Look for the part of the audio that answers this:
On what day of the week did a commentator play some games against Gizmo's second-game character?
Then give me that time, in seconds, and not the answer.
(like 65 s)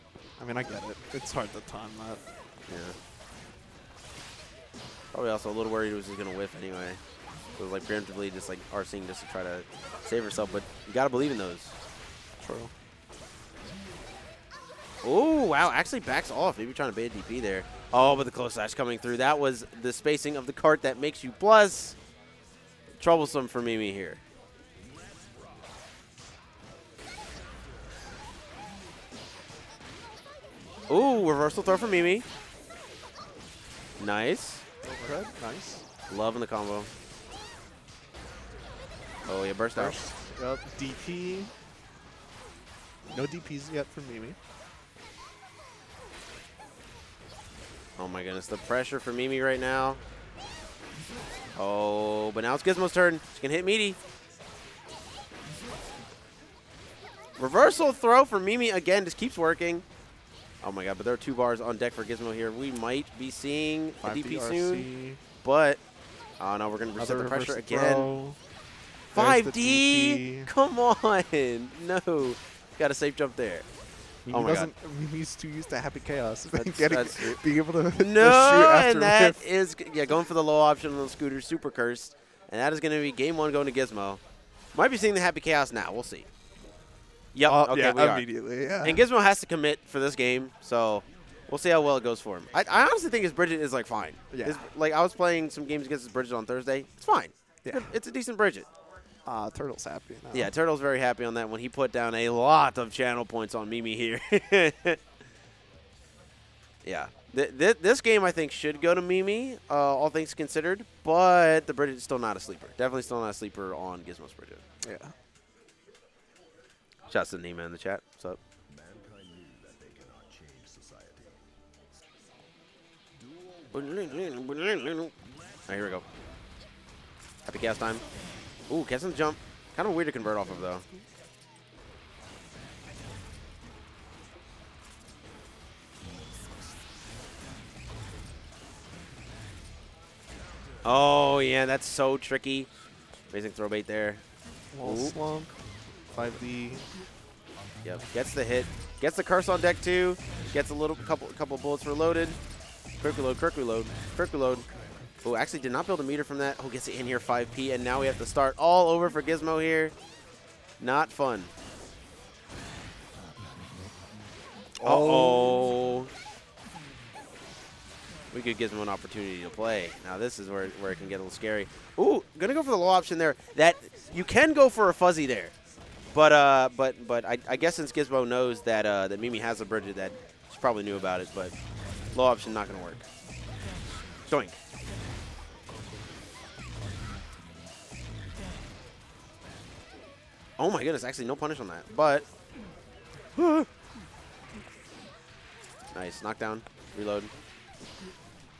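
96 s.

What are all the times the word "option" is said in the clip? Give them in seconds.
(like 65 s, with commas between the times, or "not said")
80 s, 172 s, 182 s.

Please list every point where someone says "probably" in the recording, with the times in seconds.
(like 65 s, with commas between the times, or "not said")
5 s, 180 s.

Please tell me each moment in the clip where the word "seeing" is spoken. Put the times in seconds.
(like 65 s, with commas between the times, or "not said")
63 s, 84 s.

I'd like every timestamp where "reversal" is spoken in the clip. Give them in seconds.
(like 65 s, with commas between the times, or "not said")
31 s, 57 s.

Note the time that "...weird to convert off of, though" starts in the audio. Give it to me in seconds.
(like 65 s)
129 s.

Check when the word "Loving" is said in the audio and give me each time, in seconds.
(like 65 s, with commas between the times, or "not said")
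36 s.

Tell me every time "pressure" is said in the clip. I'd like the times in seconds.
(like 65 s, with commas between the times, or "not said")
48 s, 67 s.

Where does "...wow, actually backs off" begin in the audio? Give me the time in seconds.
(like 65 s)
15 s.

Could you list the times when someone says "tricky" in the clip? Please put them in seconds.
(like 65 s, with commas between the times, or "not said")
142 s.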